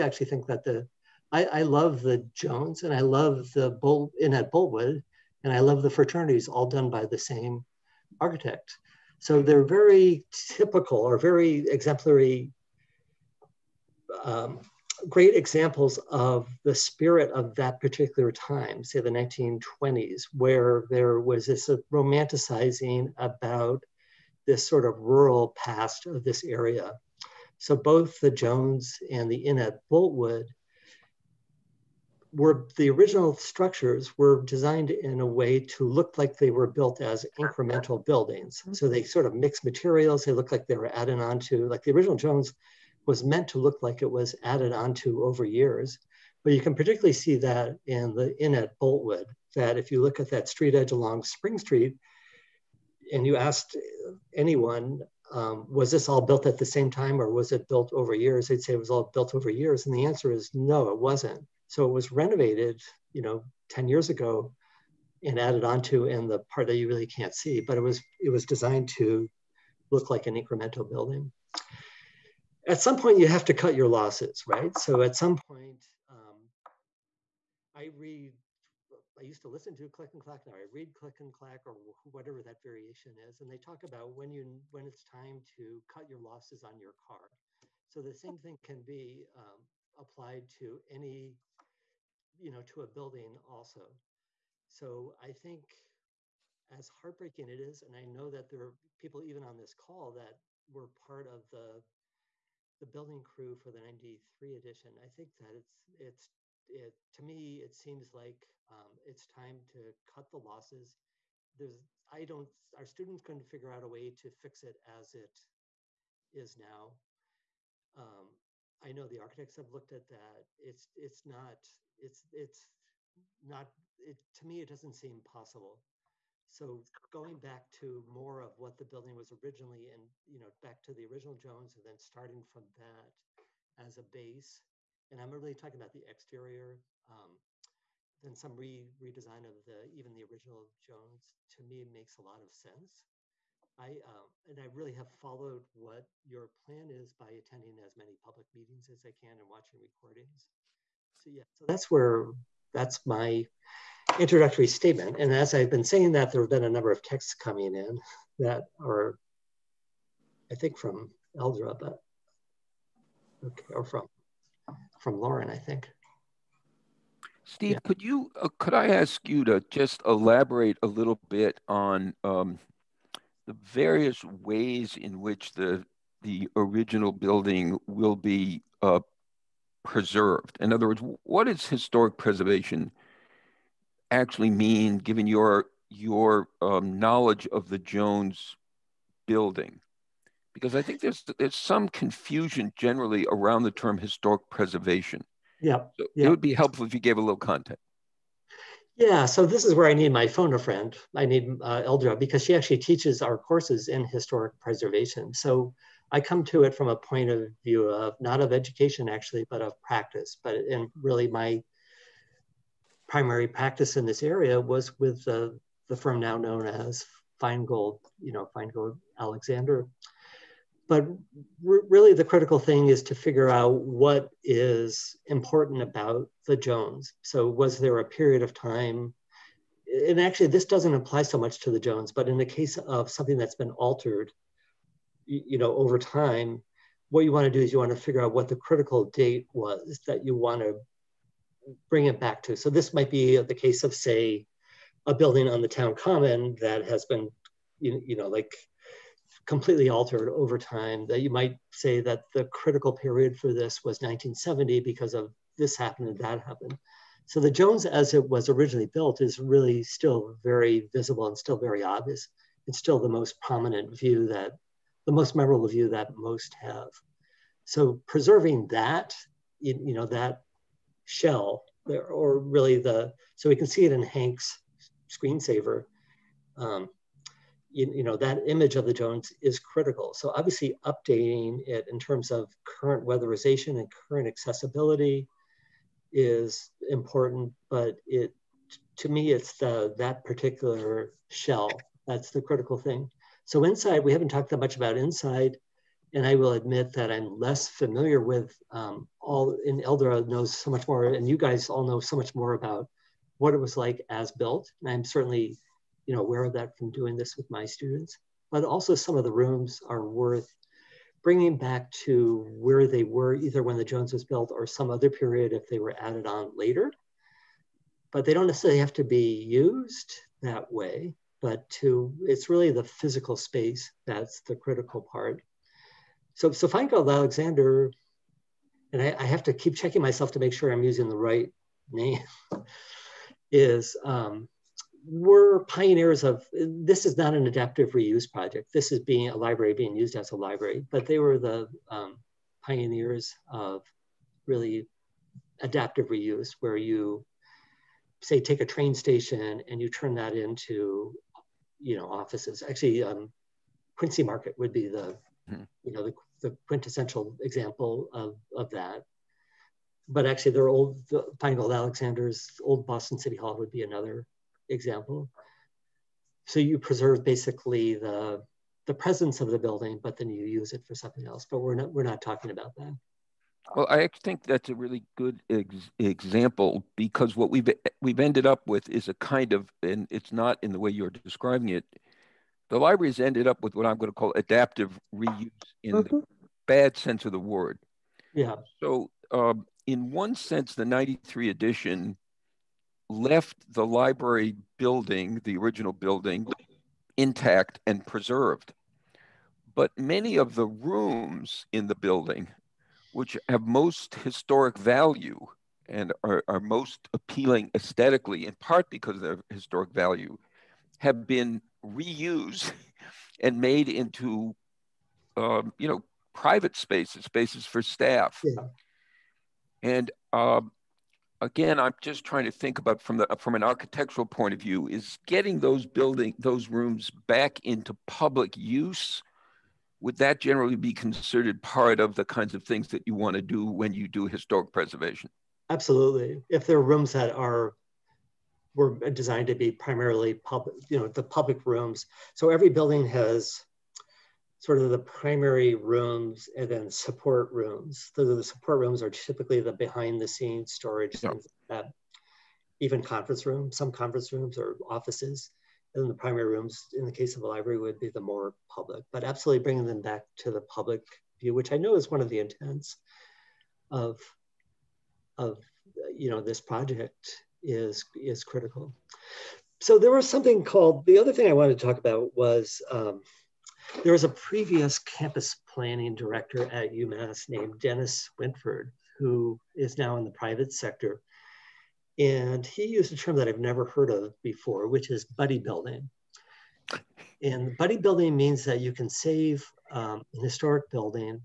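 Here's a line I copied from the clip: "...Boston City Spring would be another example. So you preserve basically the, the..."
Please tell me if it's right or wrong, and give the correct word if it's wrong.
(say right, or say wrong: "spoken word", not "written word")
wrong: "Hall", not "Spring".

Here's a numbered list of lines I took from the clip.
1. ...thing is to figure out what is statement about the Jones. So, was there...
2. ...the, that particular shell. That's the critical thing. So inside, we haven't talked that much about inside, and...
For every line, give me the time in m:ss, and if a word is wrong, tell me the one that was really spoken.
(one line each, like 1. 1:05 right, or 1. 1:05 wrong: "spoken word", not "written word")
1. 3:42 wrong: "important", not "statement"
2. 4:49 right.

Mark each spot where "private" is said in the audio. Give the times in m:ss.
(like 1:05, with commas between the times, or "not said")
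6:56, 8:00.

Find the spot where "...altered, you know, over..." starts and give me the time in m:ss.
3:53.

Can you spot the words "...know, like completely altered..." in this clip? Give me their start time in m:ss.
4:08.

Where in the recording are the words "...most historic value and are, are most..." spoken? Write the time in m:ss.
6:43.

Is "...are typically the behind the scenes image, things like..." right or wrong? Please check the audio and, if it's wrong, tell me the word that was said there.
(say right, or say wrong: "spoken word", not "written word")
wrong: "storage", not "image".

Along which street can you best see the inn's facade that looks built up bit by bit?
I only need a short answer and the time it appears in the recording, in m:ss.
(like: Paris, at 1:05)
Spring Street, at 0:51.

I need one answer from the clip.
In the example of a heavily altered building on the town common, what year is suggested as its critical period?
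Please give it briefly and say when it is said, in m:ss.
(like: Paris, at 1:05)
1970, at 4:13.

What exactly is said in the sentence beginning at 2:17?
Um, then some re redesign of the even the original Jones to me makes a lot of sense.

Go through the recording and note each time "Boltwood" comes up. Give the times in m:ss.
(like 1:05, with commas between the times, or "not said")
0:04, 0:29, 0:48.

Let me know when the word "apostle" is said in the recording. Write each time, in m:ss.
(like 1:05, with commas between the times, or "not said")
not said.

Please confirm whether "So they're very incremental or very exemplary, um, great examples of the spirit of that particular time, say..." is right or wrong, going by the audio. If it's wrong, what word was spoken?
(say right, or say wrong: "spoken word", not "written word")
wrong: "typical", not "incremental".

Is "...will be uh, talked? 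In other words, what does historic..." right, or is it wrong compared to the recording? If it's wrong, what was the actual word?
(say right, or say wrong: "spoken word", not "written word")
wrong: "preserved", not "talked".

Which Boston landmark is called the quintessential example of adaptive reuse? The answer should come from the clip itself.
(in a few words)
Quincy Market.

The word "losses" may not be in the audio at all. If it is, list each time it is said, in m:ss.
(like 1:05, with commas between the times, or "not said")
1:13, 1:26, 1:50.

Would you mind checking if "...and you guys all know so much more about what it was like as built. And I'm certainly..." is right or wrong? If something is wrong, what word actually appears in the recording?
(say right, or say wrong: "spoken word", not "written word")
right.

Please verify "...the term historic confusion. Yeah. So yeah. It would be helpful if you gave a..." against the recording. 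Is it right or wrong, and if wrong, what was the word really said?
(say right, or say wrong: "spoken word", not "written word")
wrong: "preservation", not "confusion".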